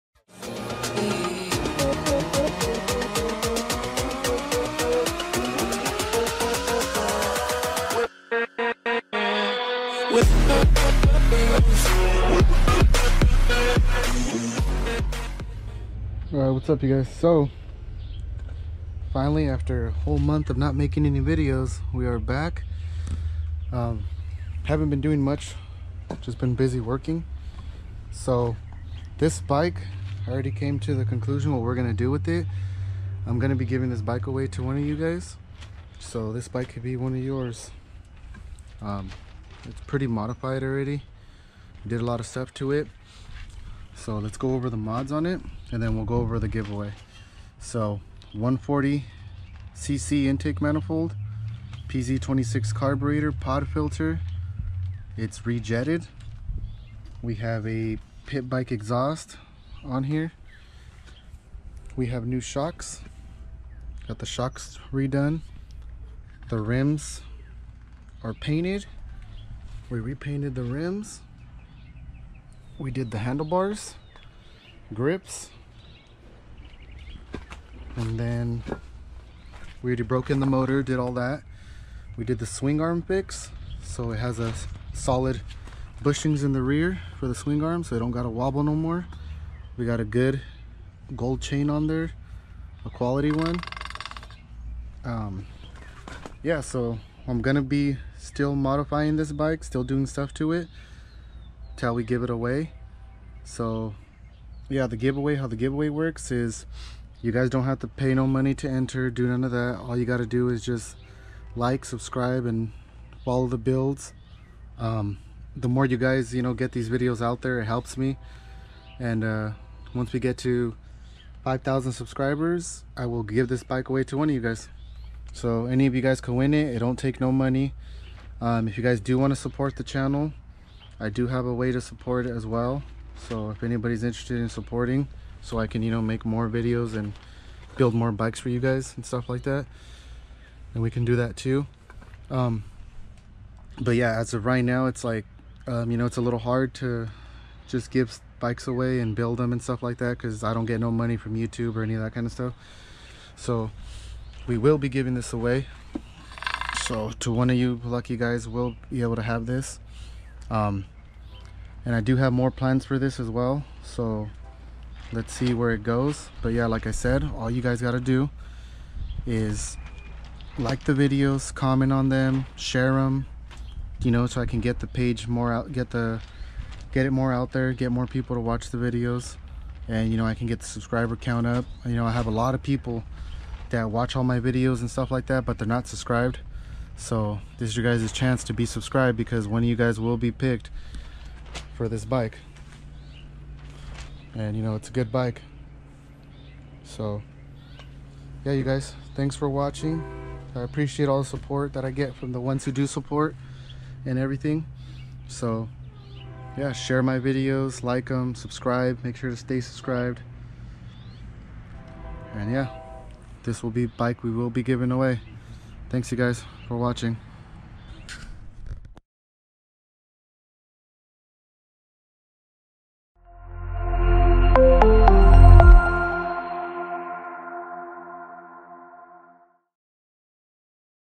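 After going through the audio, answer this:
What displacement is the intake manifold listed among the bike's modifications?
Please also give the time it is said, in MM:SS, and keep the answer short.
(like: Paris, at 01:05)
140 cc, at 00:48.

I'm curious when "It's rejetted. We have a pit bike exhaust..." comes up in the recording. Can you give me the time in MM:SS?
00:55.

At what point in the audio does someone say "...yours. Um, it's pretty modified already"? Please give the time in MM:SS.
00:37.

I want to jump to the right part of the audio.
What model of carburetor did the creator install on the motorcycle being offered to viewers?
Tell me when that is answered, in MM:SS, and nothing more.
00:51.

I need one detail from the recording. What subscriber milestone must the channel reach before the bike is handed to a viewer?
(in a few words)
5,000.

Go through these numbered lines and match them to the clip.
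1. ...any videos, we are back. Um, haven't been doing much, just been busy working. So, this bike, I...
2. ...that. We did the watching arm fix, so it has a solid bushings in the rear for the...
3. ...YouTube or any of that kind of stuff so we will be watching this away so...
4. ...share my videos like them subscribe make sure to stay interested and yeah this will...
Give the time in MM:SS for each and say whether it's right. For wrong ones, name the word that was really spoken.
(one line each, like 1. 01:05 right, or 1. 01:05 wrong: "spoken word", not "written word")
1. 00:21 right
2. 01:21 wrong: "swing", not "watching"
3. 02:31 wrong: "giving", not "watching"
4. 03:26 wrong: "subscribed", not "interested".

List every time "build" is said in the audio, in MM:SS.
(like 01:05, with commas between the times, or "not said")
01:53, 02:17, 02:29.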